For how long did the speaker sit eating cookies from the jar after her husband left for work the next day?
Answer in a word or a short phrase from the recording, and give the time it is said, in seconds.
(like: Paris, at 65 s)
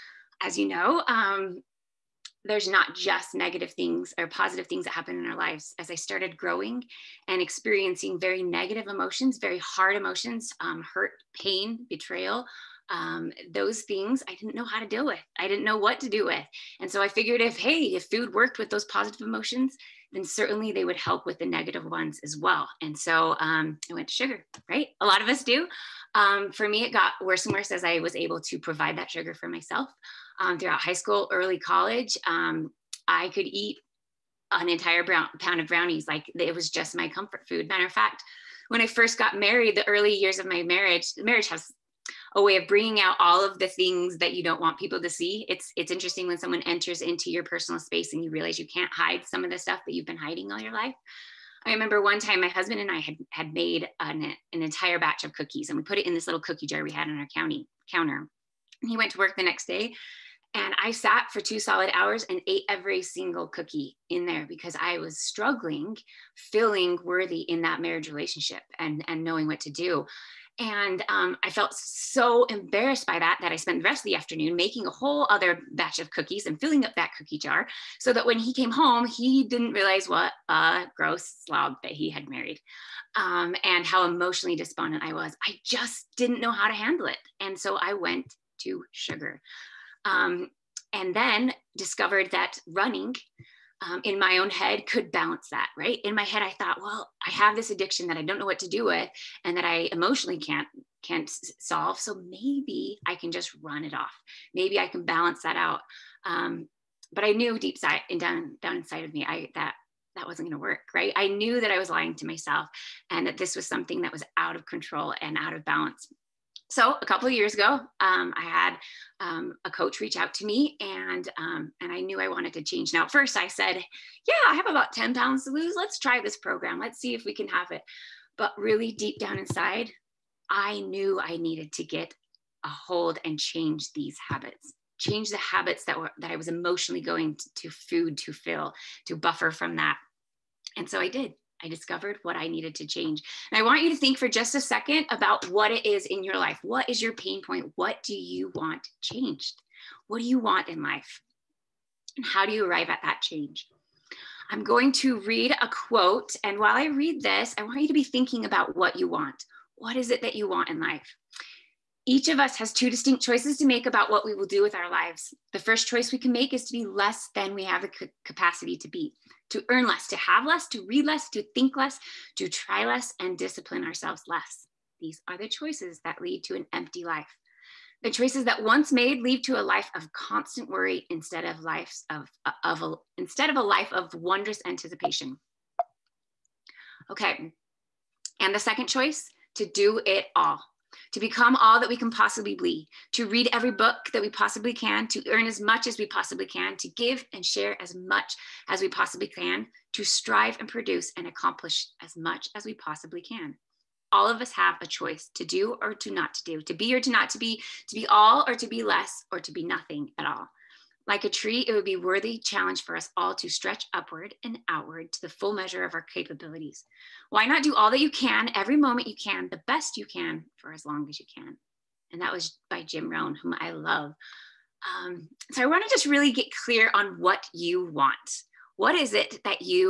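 2 hours, at 61 s.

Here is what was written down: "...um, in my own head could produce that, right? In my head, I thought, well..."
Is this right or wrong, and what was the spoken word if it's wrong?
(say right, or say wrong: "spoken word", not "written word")
wrong: "balance", not "produce".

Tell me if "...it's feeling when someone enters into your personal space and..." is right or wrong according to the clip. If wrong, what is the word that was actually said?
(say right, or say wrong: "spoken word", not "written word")
wrong: "interesting", not "feeling".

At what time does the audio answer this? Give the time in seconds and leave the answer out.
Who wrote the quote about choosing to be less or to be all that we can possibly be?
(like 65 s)
222 s.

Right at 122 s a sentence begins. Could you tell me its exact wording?
Now, first I said, "Yeah, I have about ten pounds to lose.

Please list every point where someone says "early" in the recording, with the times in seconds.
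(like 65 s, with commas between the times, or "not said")
31 s, 39 s.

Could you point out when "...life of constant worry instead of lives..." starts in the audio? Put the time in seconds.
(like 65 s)
179 s.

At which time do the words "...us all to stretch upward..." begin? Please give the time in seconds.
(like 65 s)
212 s.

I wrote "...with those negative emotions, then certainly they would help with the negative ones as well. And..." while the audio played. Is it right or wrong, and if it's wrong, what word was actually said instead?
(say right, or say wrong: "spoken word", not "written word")
wrong: "positive", not "negative".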